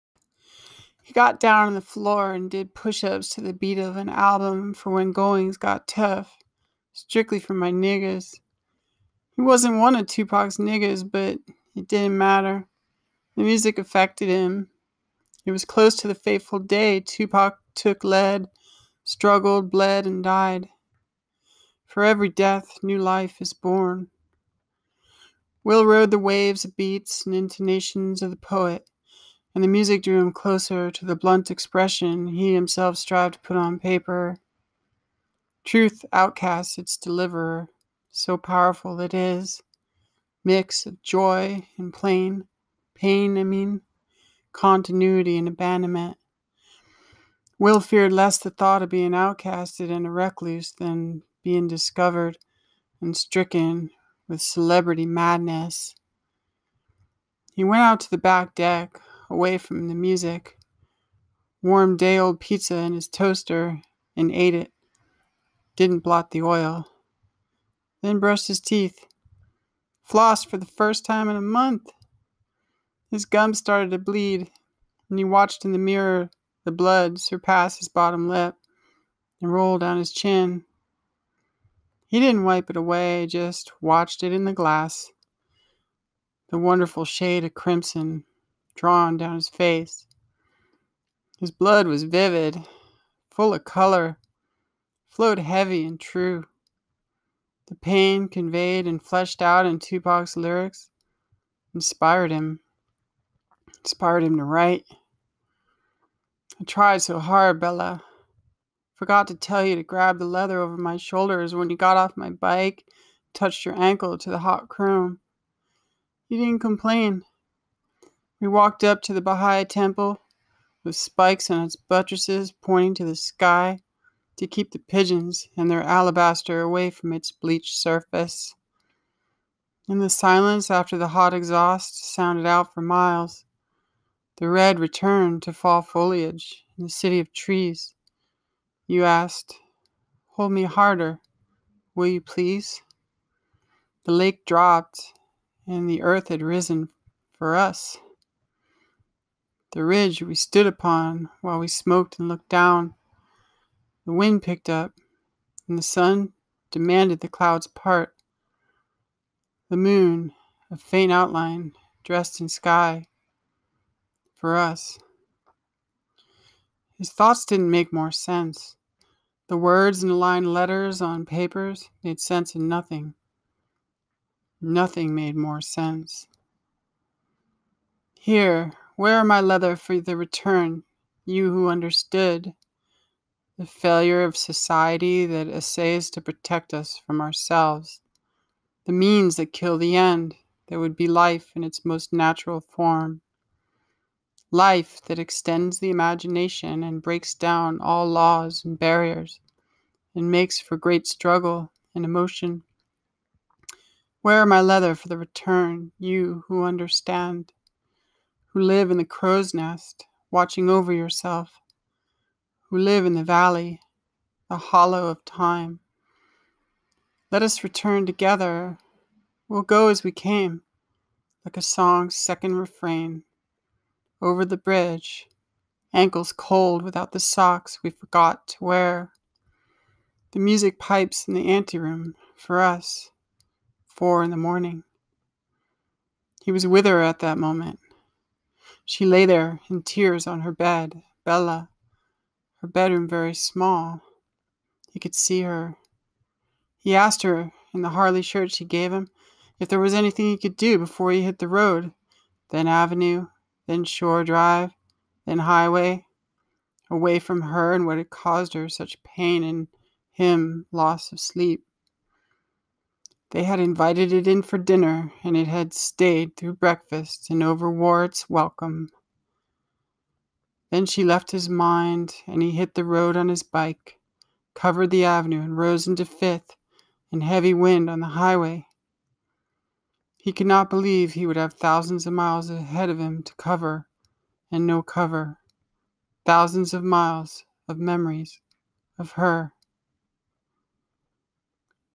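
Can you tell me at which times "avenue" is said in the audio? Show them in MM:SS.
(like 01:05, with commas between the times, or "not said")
04:12, 04:35.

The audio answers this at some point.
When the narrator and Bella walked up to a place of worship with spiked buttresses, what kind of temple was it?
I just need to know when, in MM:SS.
01:59.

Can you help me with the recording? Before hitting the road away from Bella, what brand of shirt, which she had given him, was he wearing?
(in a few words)
Harley.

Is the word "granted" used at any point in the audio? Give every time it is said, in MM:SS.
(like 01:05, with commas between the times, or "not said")
not said.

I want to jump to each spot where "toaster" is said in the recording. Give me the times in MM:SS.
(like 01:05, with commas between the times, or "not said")
01:03.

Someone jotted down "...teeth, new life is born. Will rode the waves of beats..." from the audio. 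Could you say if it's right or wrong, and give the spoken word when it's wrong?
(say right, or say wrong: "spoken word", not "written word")
wrong: "death", not "teeth".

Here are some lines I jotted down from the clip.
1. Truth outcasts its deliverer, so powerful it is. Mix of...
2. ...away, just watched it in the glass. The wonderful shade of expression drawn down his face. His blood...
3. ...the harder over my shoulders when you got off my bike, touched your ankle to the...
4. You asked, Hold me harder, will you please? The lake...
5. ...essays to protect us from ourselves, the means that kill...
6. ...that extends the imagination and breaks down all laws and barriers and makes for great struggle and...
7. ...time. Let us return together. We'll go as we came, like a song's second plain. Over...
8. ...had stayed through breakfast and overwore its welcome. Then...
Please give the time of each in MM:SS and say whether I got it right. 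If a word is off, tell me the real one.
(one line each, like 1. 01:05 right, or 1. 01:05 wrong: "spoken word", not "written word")
1. 00:35 right
2. 01:22 wrong: "crimson", not "expression"
3. 01:50 wrong: "leather", not "harder"
4. 02:18 right
5. 03:05 right
6. 03:15 right
7. 03:35 wrong: "refrain", not "plain"
8. 04:25 right.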